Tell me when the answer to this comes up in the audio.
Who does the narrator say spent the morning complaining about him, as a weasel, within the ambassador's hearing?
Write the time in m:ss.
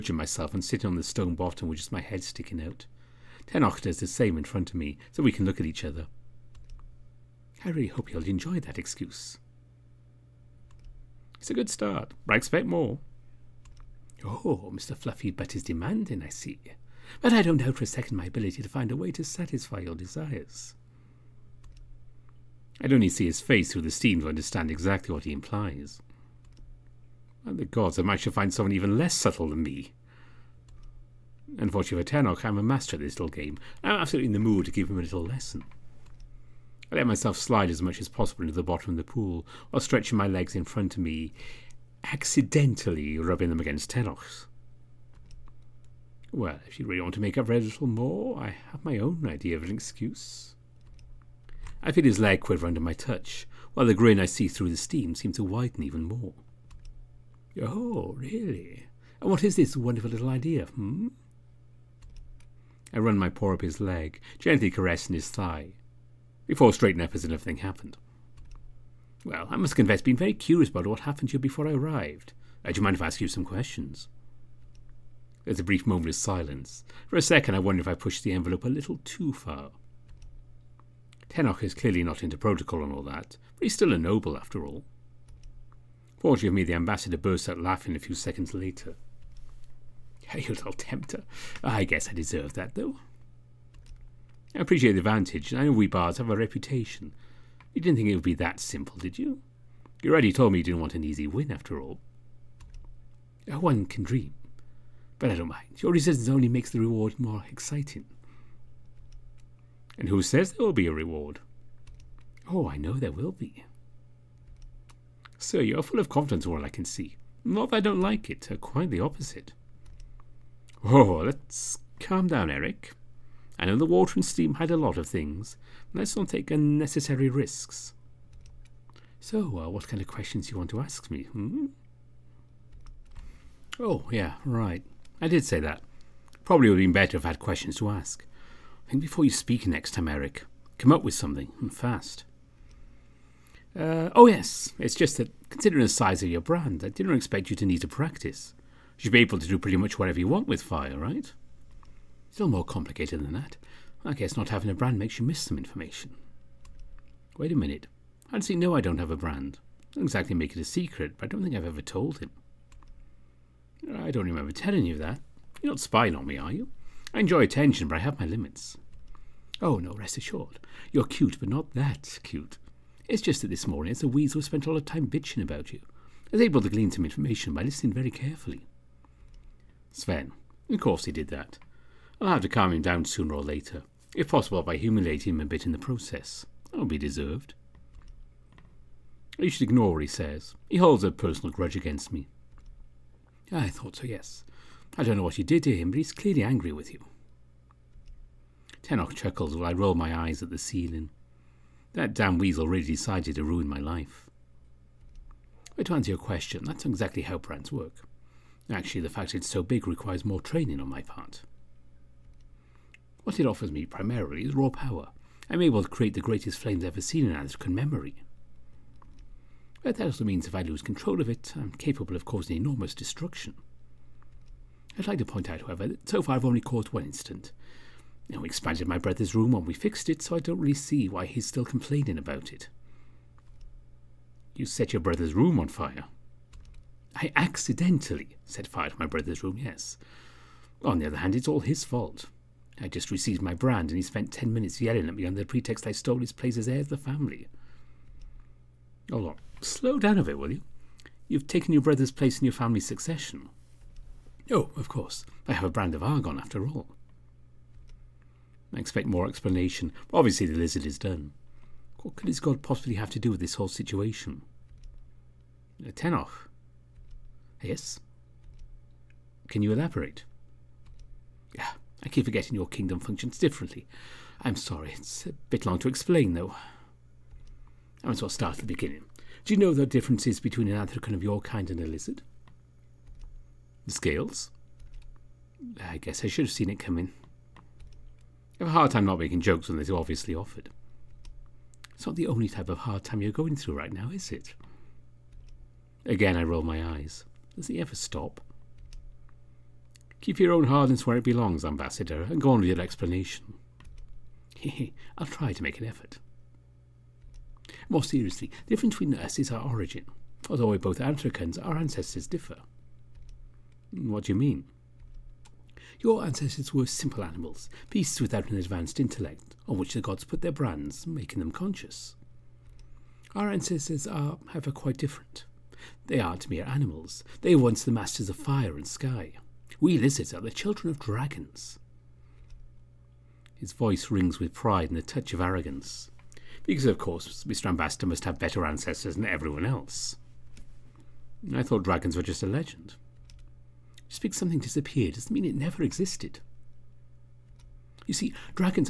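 2:59.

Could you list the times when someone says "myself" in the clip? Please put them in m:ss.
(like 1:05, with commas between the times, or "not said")
0:00, 0:37.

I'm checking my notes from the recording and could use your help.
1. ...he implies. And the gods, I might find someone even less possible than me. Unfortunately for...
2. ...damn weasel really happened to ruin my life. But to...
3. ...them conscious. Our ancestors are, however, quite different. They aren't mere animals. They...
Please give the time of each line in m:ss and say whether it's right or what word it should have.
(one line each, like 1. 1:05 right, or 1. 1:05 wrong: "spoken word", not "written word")
1. 0:25 wrong: "subtle", not "possible"
2. 3:22 wrong: "decided", not "happened"
3. 5:21 right.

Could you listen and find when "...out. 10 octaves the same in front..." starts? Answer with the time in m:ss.
0:02.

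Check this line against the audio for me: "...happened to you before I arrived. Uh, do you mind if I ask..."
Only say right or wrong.
right.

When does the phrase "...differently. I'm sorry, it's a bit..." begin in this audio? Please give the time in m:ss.
4:33.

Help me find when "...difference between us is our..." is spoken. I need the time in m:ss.
5:08.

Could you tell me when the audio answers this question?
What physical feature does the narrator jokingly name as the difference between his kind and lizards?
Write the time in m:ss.
4:43.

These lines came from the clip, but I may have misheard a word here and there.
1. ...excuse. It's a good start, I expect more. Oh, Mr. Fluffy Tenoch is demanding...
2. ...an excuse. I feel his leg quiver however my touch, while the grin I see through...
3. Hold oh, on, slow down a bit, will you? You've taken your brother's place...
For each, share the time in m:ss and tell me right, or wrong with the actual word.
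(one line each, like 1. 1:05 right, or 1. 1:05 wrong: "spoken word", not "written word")
1. 0:08 wrong: "Butt", not "Tenoch"
2. 0:49 wrong: "under", not "however"
3. 4:09 right.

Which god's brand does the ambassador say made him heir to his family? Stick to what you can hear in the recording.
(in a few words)
Argon.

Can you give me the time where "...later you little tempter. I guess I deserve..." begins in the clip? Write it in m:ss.
1:28.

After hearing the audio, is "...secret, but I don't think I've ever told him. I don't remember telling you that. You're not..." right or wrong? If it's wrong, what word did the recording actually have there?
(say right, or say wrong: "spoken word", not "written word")
right.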